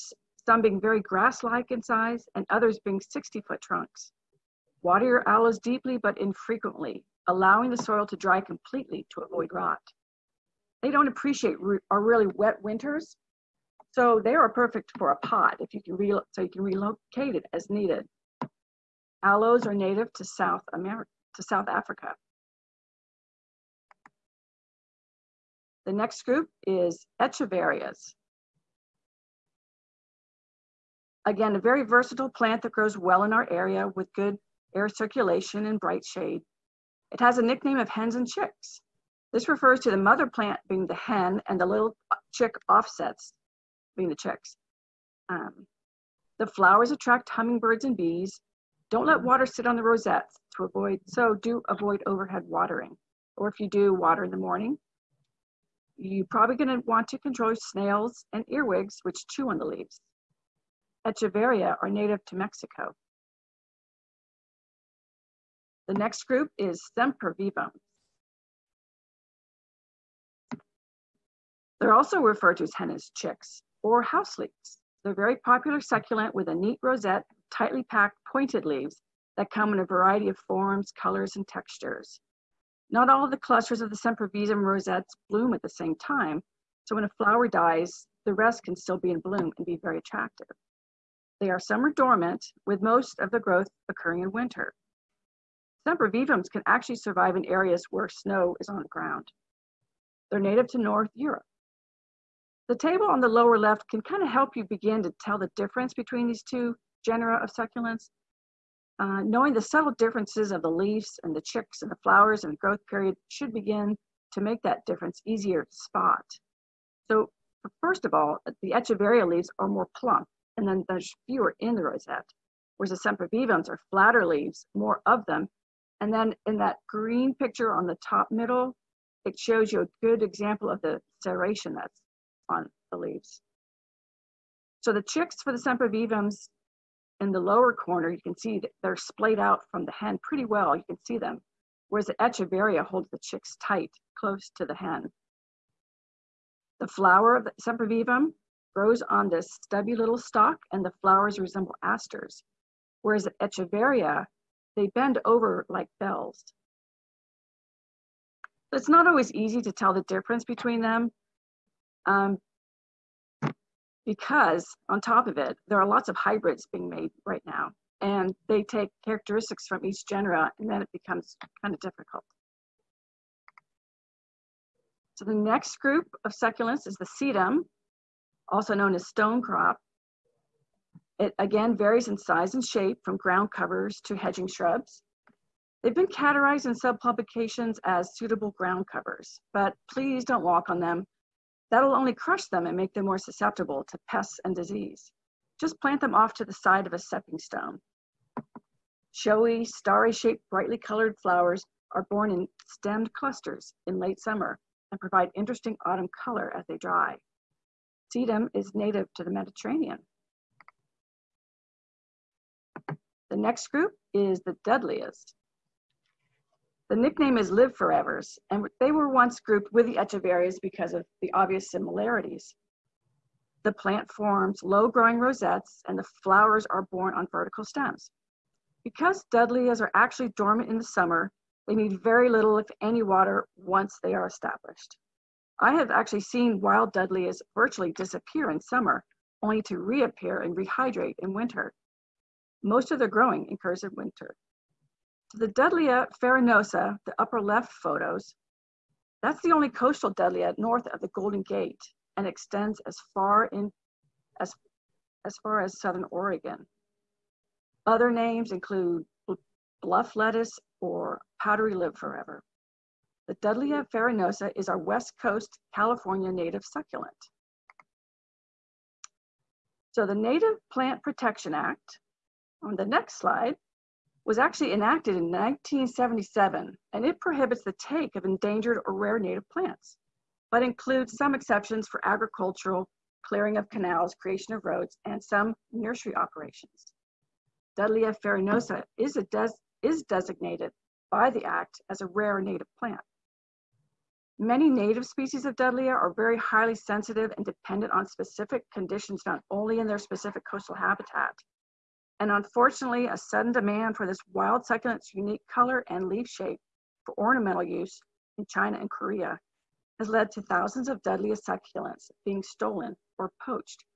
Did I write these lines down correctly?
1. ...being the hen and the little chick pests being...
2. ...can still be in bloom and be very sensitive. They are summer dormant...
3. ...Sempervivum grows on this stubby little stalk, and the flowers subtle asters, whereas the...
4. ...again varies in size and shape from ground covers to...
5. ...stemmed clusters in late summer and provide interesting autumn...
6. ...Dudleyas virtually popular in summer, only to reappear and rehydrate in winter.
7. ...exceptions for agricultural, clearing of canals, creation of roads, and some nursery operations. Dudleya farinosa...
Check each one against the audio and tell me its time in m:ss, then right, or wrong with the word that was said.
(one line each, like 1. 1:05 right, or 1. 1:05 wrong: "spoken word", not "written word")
1. 0:40 wrong: "offsets", not "pests"
2. 1:28 wrong: "attractive", not "sensitive"
3. 2:27 wrong: "resemble", not "subtle"
4. 3:01 right
5. 3:22 right
6. 3:56 wrong: "disappear", not "popular"
7. 4:41 right.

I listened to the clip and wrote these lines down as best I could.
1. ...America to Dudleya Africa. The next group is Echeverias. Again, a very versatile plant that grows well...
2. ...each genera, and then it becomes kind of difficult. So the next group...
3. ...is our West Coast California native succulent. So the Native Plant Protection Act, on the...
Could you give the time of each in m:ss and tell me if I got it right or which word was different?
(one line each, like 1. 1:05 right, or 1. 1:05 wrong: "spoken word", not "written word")
1. 0:20 wrong: "South", not "Dudleya"
2. 2:49 right
3. 4:24 right.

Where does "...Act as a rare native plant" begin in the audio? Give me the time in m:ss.
4:51.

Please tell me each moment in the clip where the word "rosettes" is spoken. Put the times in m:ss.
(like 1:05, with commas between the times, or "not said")
0:49, 1:16, 1:24, 2:01, 3:45.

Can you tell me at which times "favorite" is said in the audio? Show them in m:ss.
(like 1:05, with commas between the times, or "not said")
not said.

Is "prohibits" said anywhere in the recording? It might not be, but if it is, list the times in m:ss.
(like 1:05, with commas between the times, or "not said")
4:37.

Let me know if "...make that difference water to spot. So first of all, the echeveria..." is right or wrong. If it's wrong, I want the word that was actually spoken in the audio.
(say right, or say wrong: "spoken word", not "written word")
wrong: "easier", not "water".